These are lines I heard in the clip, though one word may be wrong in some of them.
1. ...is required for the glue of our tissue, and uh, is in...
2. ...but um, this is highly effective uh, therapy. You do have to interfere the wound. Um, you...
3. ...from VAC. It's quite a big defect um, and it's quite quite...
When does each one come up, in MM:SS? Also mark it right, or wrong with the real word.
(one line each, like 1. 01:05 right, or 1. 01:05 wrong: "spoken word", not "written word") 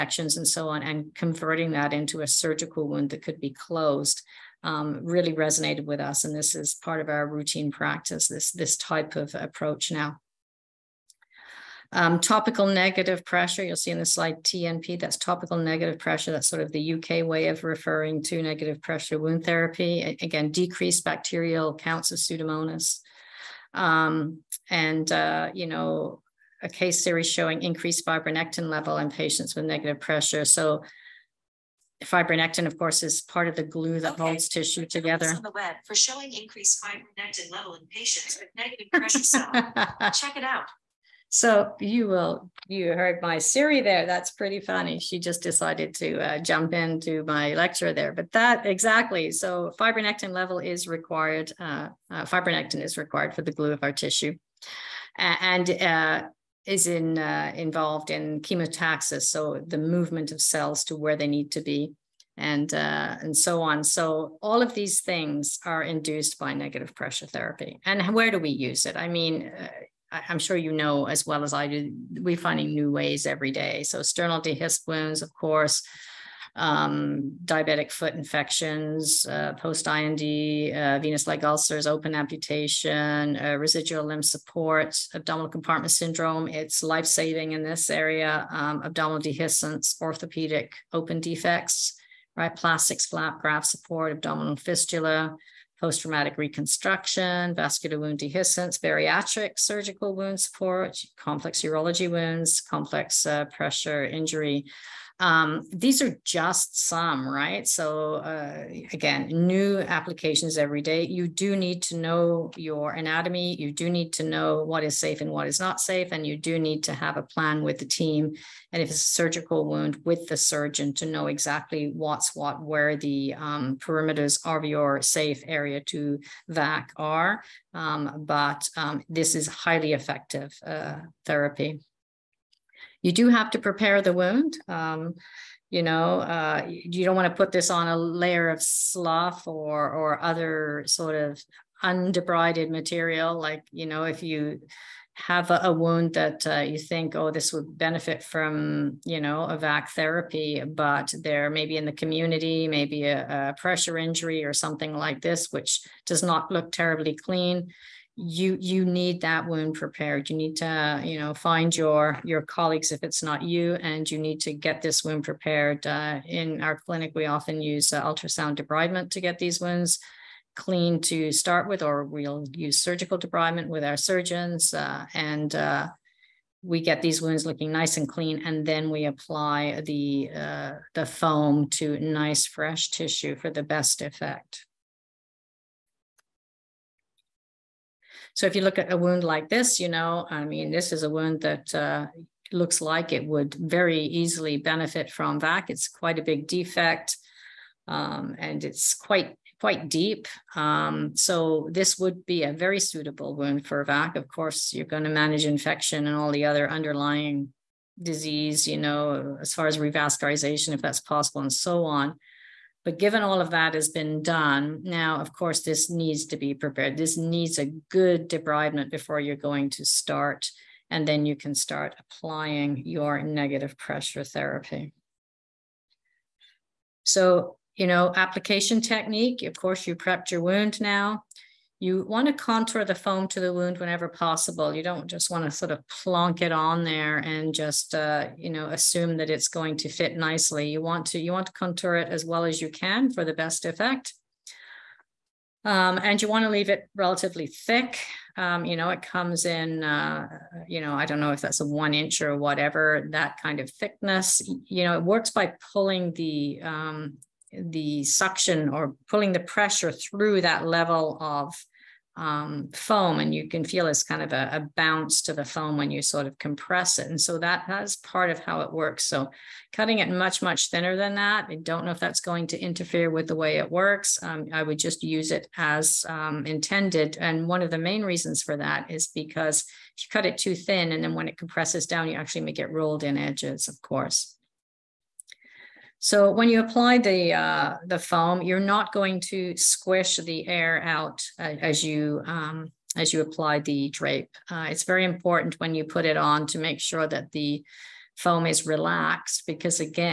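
1. 00:52 right
2. 02:08 wrong: "prepare", not "interfere"
3. 03:15 right.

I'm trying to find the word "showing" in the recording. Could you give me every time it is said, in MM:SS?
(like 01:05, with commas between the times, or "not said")
00:27, 00:35.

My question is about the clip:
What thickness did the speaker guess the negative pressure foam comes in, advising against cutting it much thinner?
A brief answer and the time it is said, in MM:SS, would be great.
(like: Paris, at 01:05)
1 inch, at 04:11.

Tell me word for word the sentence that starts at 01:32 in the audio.
Plastics, flap graft support, abdominal fistula.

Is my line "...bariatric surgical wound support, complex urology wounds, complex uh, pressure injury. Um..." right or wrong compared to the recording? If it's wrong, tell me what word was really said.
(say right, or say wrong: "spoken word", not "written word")
right.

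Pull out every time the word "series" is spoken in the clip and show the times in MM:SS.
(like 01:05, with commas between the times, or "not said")
00:27.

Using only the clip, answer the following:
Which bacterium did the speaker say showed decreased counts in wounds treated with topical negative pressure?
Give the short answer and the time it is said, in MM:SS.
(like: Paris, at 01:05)
Pseudomonas, at 00:22.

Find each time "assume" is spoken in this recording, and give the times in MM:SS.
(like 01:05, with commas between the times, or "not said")
03:58.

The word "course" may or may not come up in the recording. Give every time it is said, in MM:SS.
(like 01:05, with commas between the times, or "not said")
00:32, 01:15, 03:24, 03:35, 03:49, 04:43.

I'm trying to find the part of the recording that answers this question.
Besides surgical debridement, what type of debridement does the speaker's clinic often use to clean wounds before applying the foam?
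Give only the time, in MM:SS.
02:48.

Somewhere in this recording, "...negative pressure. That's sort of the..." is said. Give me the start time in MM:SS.
00:15.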